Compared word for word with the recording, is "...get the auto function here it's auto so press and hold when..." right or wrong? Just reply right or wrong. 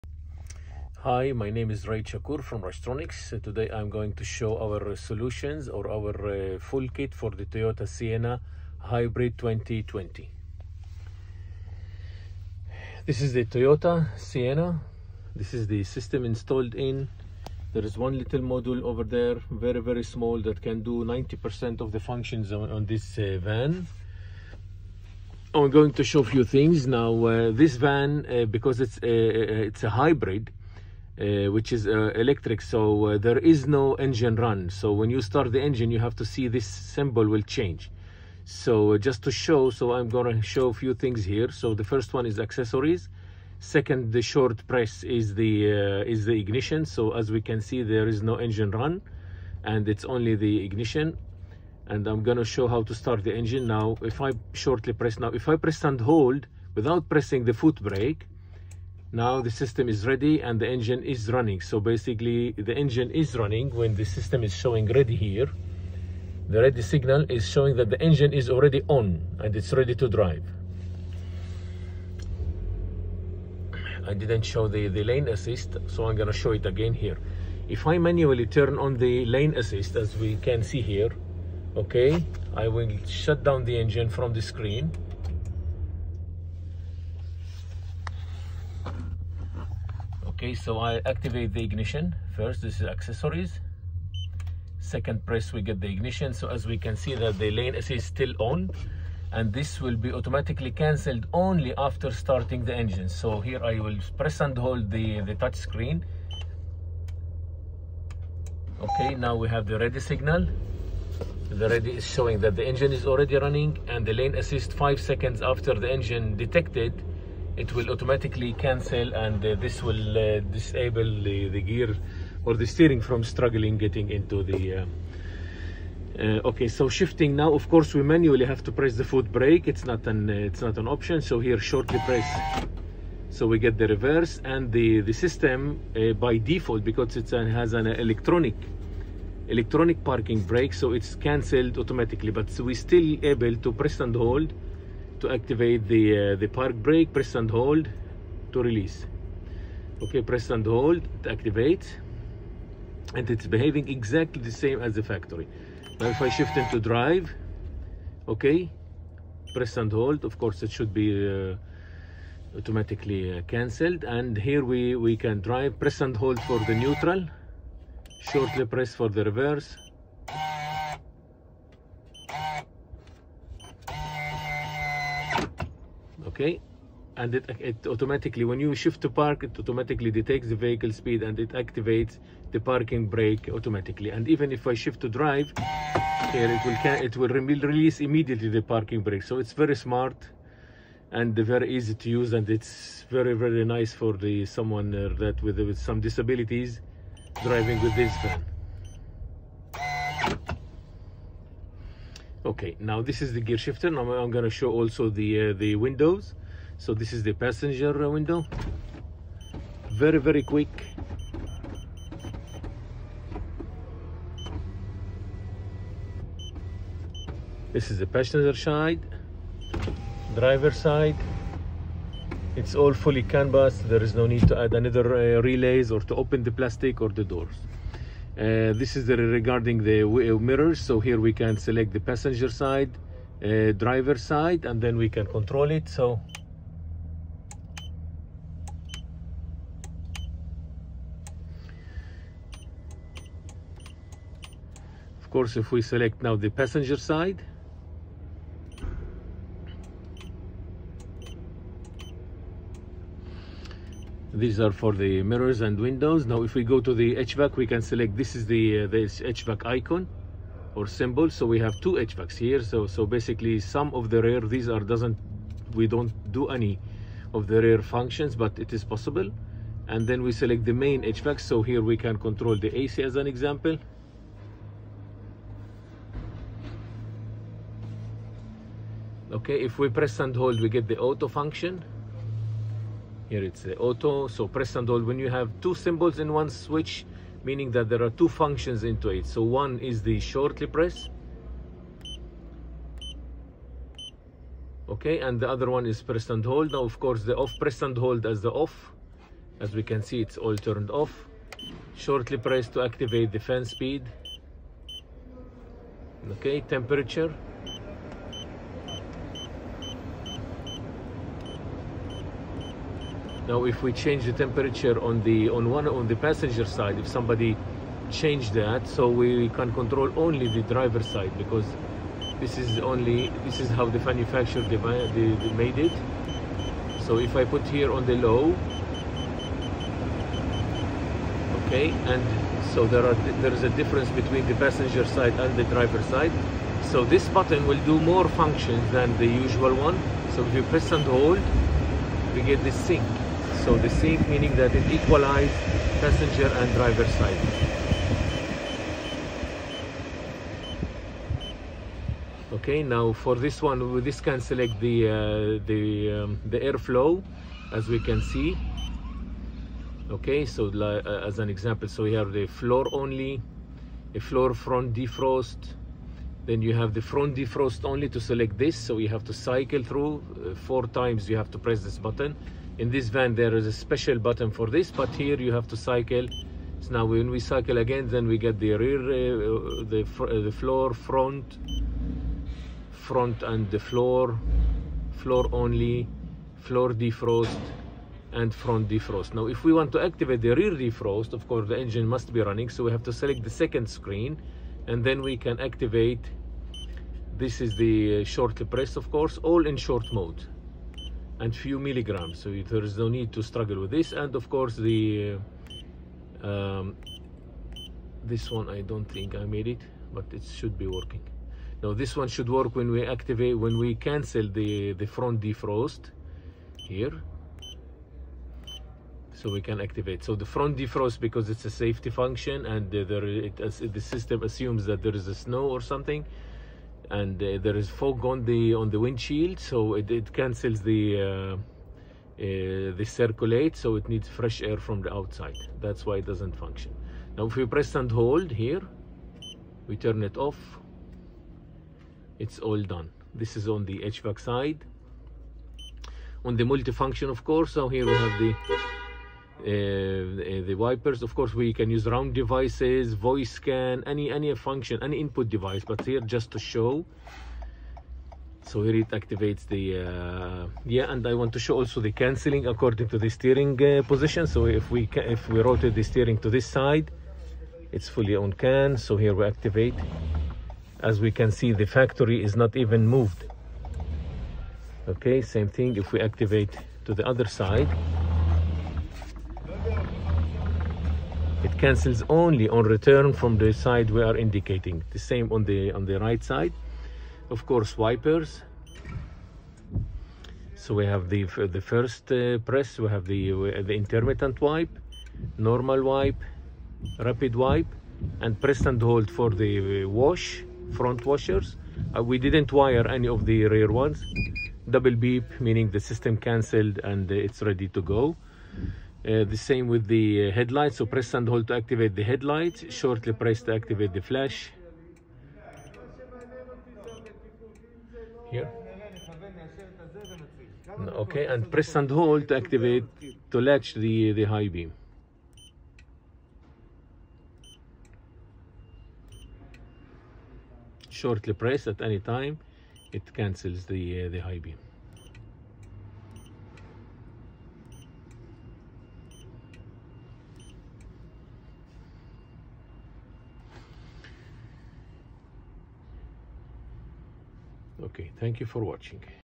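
right.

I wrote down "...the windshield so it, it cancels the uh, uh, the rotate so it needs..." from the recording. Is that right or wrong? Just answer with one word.
wrong.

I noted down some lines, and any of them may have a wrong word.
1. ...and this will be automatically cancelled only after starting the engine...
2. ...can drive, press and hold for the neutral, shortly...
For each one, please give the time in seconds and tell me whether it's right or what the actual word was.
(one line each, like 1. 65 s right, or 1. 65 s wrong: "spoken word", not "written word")
1. 99 s right
2. 165 s right.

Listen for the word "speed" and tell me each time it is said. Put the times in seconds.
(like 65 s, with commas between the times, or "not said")
180 s, 303 s.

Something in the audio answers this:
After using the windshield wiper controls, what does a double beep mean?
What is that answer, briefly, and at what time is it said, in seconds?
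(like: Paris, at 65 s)
system cancelled, at 505 s.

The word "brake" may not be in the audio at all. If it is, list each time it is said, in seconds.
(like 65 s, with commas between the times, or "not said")
57 s, 129 s, 140 s, 146 s, 183 s, 189 s.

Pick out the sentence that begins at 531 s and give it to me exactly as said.
Shortly press at any time, it cancels the, uh, the high beam.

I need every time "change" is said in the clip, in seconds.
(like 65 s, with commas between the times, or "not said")
37 s, 313 s, 318 s.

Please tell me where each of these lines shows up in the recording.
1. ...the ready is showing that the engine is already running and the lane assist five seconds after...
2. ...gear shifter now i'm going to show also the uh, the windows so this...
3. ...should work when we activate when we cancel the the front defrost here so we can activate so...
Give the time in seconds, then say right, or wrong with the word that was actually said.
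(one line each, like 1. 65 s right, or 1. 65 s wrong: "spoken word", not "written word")
1. 111 s right
2. 203 s right
3. 412 s right.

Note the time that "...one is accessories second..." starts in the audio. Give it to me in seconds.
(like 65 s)
42 s.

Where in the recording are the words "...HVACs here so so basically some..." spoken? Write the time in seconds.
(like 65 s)
262 s.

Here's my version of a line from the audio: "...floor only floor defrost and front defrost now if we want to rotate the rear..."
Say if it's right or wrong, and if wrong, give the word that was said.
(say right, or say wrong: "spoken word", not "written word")
wrong: "activate", not "rotate".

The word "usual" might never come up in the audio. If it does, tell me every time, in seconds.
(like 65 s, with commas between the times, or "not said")
339 s.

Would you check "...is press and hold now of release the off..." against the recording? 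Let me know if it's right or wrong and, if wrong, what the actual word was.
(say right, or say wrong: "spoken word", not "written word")
wrong: "course", not "release".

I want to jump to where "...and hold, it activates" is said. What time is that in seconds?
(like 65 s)
150 s.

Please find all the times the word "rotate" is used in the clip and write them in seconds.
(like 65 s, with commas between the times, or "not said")
465 s.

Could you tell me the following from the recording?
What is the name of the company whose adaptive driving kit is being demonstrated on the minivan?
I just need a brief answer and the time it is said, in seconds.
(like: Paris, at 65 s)
Rastronics, at 2 s.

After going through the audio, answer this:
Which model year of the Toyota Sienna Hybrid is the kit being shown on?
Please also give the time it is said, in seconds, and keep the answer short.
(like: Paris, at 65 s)
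2020, at 9 s.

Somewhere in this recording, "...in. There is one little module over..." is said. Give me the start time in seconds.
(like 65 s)
16 s.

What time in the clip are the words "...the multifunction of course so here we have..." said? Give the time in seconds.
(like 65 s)
446 s.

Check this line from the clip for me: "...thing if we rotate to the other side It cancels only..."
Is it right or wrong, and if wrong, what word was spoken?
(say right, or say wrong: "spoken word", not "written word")
wrong: "activate", not "rotate".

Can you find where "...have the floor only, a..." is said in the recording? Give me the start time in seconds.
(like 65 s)
362 s.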